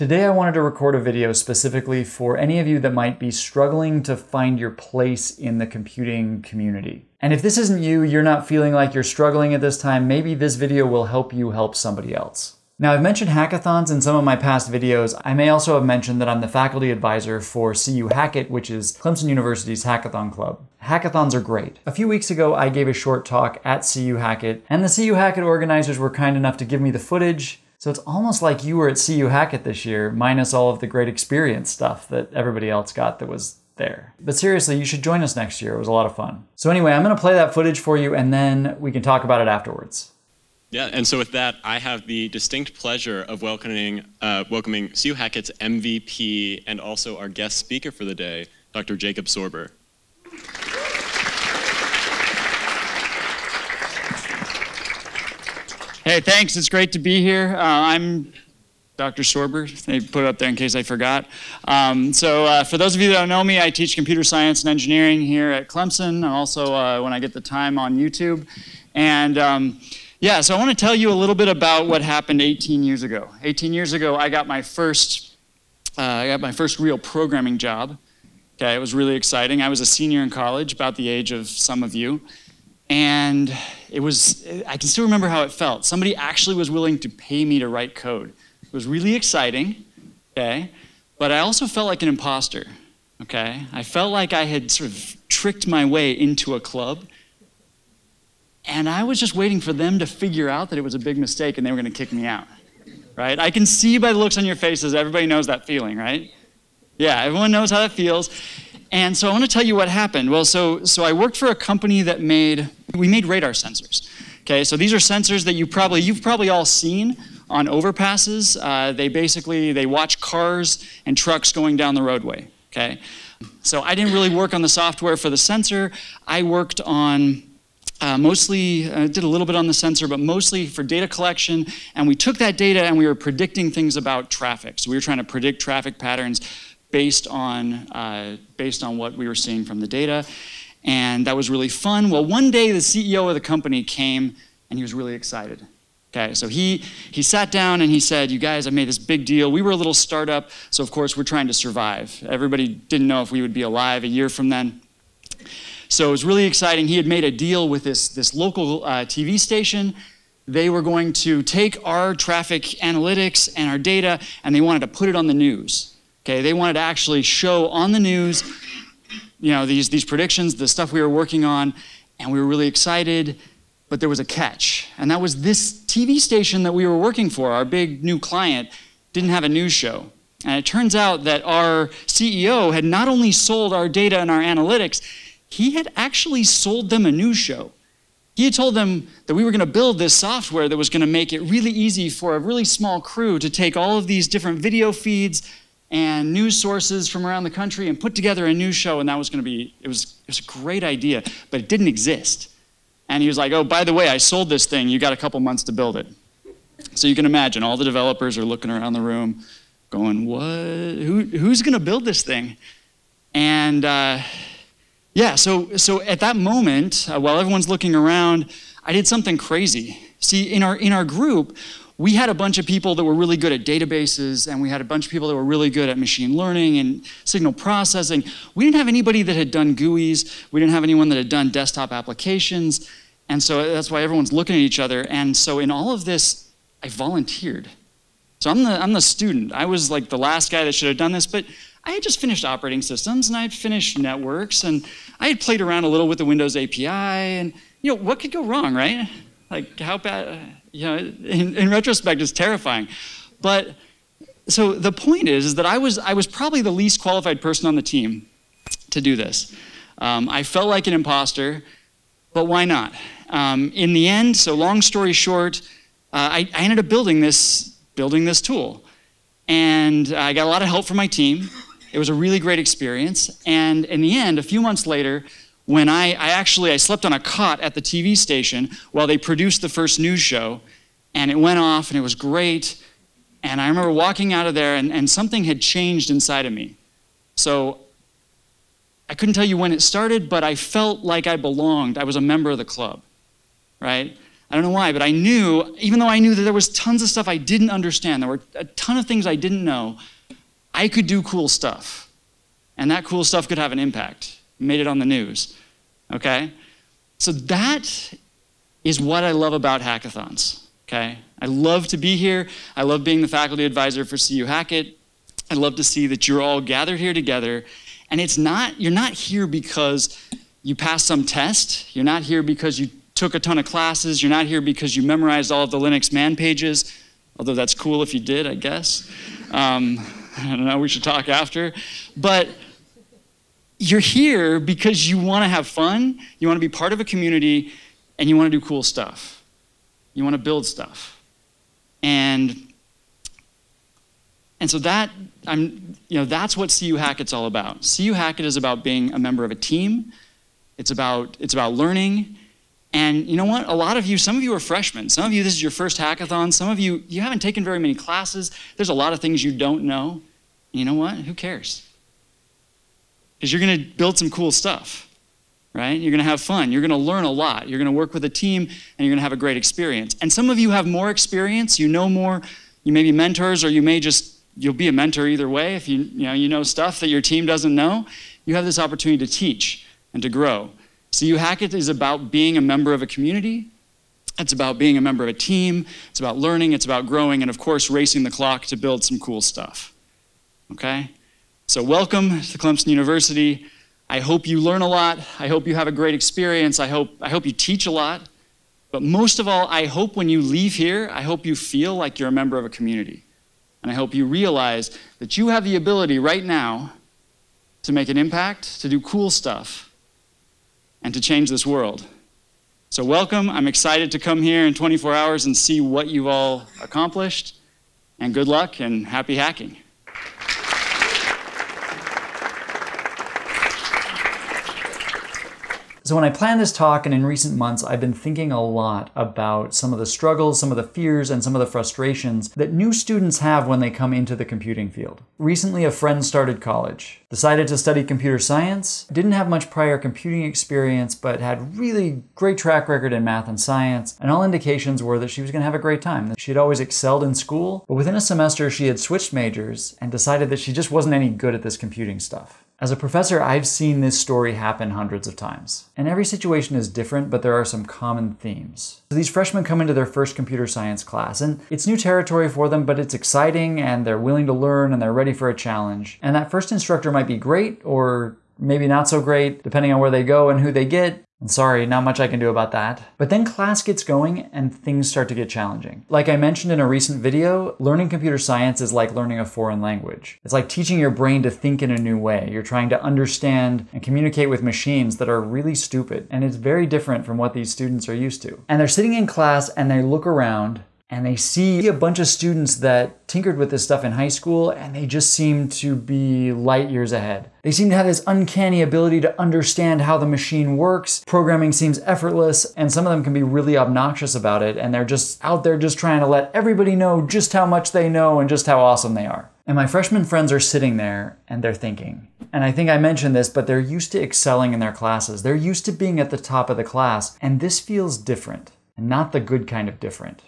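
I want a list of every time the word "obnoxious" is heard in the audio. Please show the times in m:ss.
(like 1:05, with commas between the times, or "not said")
8:23.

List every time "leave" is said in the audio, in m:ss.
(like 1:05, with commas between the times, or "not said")
6:40.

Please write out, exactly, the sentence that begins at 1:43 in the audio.
I can see by the looks on your faces, everybody knows that feeling, right?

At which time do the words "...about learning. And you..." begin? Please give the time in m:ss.
5:51.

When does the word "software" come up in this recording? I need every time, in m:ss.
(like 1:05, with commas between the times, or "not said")
2:04, 3:10.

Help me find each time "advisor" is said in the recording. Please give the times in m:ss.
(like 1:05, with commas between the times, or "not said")
0:16, 5:13.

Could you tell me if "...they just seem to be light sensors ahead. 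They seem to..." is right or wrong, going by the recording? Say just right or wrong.
wrong.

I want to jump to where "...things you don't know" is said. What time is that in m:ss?
5:59.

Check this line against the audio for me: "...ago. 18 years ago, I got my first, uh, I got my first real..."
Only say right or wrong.
right.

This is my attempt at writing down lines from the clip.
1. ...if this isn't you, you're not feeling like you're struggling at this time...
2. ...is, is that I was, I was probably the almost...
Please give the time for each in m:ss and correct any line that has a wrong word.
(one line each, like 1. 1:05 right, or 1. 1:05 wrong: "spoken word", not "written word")
1. 0:07 right
2. 4:15 wrong: "least", not "almost".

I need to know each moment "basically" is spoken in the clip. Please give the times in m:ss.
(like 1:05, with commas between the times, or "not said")
1:59.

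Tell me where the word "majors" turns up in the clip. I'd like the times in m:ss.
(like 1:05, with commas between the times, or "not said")
7:29.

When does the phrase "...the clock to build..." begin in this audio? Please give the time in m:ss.
6:28.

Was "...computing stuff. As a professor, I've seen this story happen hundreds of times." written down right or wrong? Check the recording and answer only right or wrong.
right.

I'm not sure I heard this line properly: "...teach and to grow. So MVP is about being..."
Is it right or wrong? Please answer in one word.
wrong.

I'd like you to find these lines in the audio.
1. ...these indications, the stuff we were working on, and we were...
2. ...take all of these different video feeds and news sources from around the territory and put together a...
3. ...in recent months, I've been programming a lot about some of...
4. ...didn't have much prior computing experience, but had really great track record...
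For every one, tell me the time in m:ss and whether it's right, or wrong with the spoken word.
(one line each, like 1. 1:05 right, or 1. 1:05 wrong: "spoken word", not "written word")
1. 2:49 wrong: "predictions", not "indications"
2. 3:13 wrong: "country", not "territory"
3. 7:07 wrong: "thinking", not "programming"
4. 7:19 right.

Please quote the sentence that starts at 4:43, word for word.
And I remember walking out of there and, and something had changed inside of me.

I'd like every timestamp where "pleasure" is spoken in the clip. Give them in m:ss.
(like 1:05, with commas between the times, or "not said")
0:42.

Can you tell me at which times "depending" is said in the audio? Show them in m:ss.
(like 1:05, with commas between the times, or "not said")
7:49.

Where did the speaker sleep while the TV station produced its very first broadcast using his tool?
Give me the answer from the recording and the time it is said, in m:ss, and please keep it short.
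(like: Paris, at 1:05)
On a cot, at 4:37.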